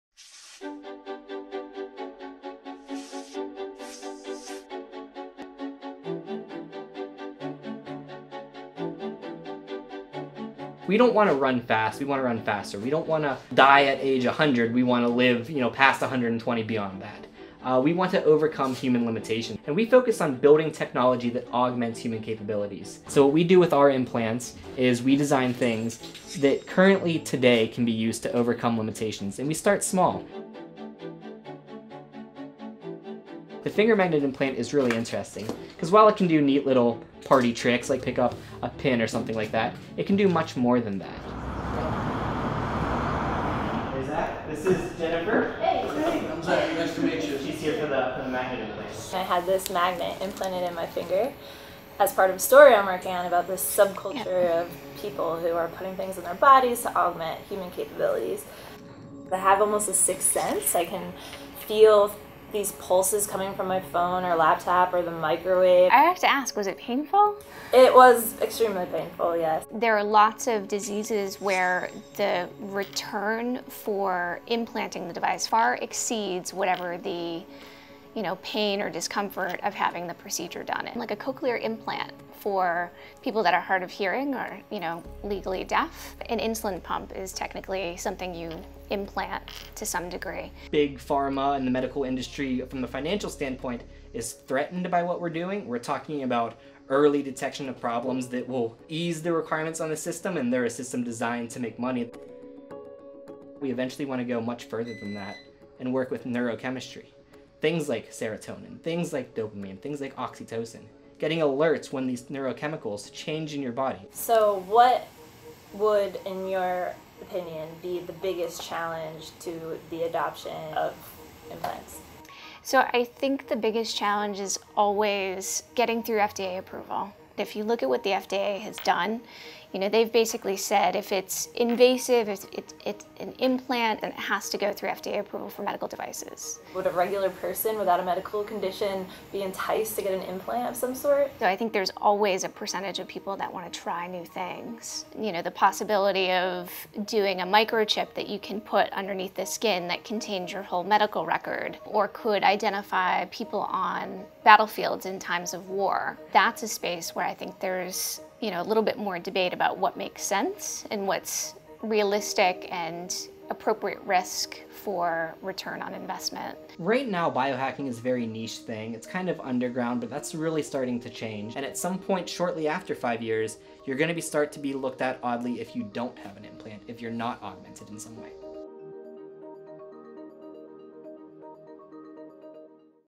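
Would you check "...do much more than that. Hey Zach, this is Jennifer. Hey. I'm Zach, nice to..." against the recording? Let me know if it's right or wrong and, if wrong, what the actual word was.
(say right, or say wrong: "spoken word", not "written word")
right.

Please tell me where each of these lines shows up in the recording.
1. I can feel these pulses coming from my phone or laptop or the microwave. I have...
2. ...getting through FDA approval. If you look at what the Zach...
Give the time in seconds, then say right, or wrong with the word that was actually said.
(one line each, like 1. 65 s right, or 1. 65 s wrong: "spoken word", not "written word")
1. 60 s right
2. 125 s wrong: "FDA", not "Zach".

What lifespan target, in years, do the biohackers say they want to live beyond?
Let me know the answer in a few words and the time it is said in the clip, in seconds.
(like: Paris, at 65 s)
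120, at 16 s.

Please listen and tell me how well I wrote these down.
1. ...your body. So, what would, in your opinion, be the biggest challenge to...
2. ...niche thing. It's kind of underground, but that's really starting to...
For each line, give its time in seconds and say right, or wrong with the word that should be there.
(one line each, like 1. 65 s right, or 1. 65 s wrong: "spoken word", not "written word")
1. 113 s right
2. 168 s right.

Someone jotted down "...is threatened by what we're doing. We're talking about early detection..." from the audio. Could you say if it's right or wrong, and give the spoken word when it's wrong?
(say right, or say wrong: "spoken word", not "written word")
right.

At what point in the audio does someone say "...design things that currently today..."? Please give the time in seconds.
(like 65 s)
25 s.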